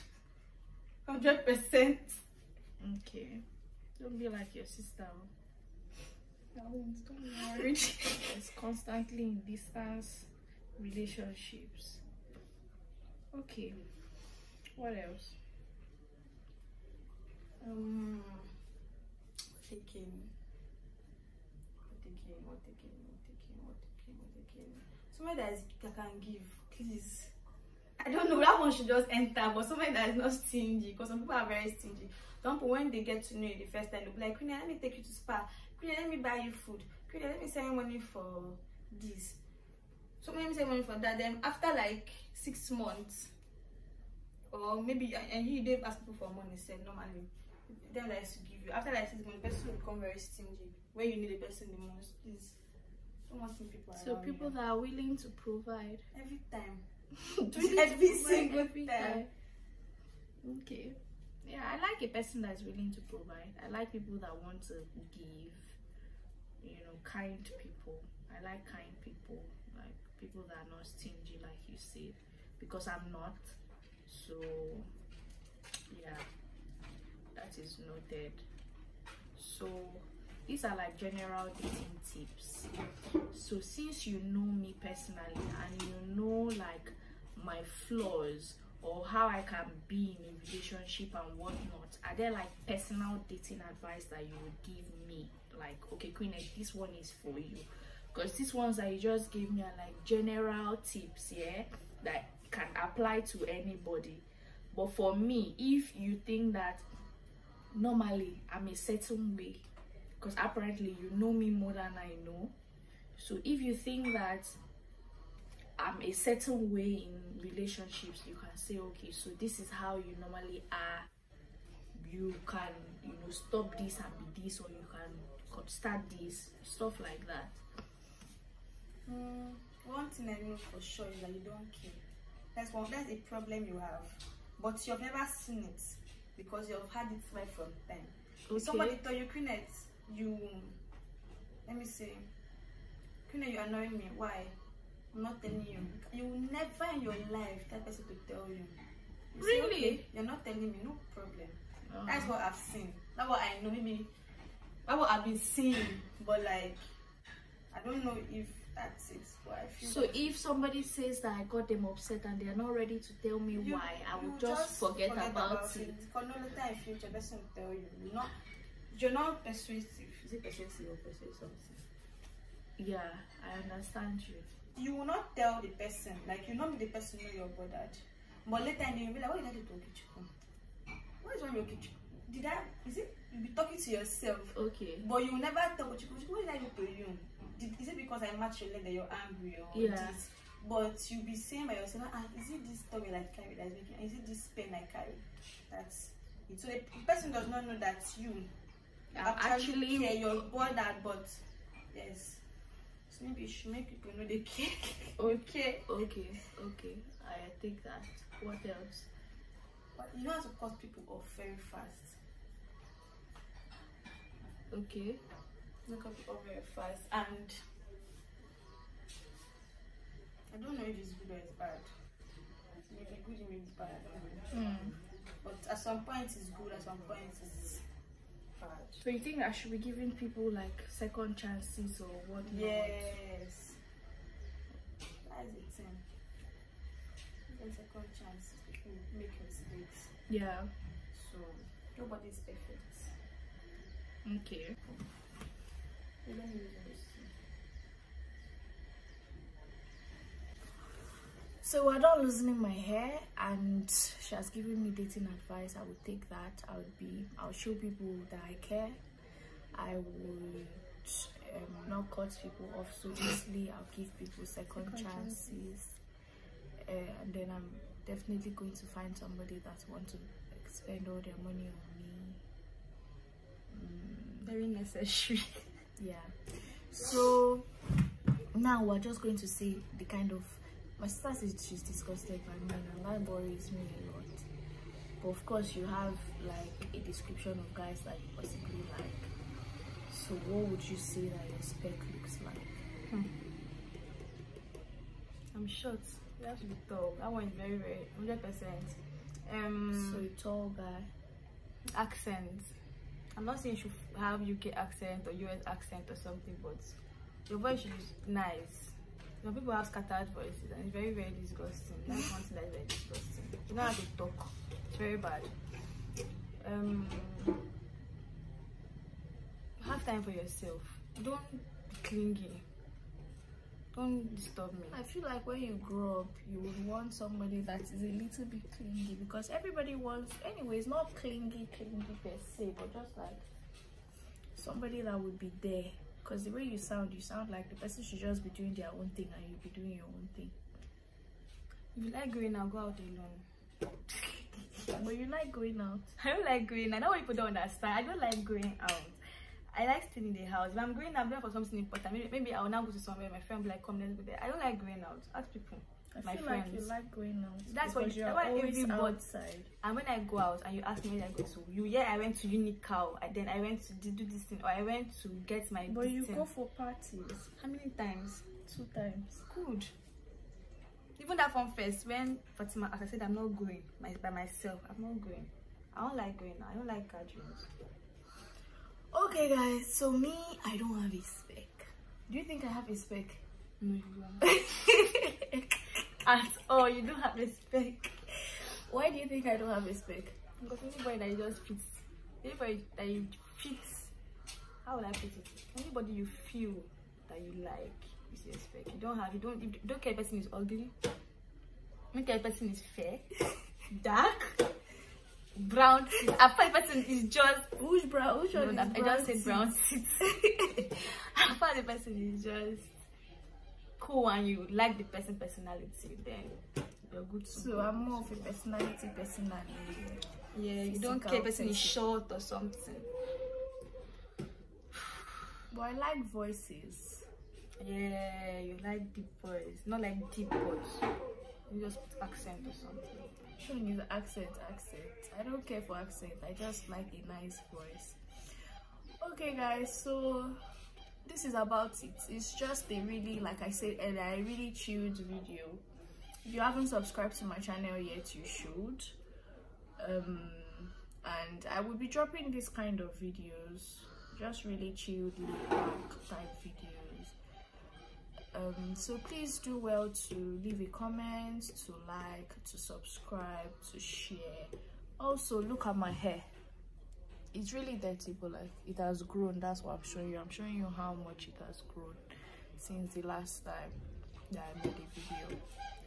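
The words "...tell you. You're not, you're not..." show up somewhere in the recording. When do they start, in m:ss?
2:47.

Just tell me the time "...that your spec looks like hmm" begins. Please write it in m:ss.
4:51.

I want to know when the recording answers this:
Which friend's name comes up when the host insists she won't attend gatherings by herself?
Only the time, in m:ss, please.
6:12.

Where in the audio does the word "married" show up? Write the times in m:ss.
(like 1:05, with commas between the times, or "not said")
0:07.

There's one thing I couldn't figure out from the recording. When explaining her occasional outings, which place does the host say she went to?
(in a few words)
Unical.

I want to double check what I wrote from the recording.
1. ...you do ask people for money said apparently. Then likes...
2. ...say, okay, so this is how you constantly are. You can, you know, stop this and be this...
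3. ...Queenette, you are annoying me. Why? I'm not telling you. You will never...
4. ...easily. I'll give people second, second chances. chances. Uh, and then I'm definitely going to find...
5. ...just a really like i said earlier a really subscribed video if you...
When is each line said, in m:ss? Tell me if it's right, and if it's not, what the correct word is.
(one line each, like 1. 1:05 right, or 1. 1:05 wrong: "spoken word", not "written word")
1. 0:45 wrong: "normally", not "apparently"
2. 1:58 wrong: "normally", not "constantly"
3. 2:23 right
4. 4:23 right
5. 7:22 wrong: "chilled", not "subscribed".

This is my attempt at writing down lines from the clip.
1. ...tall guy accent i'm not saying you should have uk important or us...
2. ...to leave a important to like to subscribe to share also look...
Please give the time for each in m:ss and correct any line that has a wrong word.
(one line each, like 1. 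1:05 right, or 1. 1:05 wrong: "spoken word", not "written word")
1. 5:00 wrong: "accent", not "important"
2. 7:40 wrong: "comment", not "important".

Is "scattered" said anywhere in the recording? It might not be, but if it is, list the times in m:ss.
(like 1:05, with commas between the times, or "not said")
5:09.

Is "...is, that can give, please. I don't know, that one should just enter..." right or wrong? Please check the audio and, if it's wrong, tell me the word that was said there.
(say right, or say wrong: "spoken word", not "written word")
right.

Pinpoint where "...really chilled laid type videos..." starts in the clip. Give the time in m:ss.
7:34.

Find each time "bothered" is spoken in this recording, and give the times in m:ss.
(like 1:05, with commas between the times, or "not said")
2:57, 3:20.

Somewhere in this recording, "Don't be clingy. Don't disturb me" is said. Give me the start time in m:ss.
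5:21.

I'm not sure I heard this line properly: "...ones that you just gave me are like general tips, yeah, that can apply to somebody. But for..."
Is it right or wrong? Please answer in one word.
wrong.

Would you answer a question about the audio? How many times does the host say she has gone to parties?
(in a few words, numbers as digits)
2.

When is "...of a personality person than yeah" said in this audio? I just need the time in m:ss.
6:58.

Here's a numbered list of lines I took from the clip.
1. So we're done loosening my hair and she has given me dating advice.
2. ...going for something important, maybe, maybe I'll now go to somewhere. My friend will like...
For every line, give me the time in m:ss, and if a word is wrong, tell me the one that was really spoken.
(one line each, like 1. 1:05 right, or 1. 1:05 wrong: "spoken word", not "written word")
1. 4:11 right
2. 5:51 right.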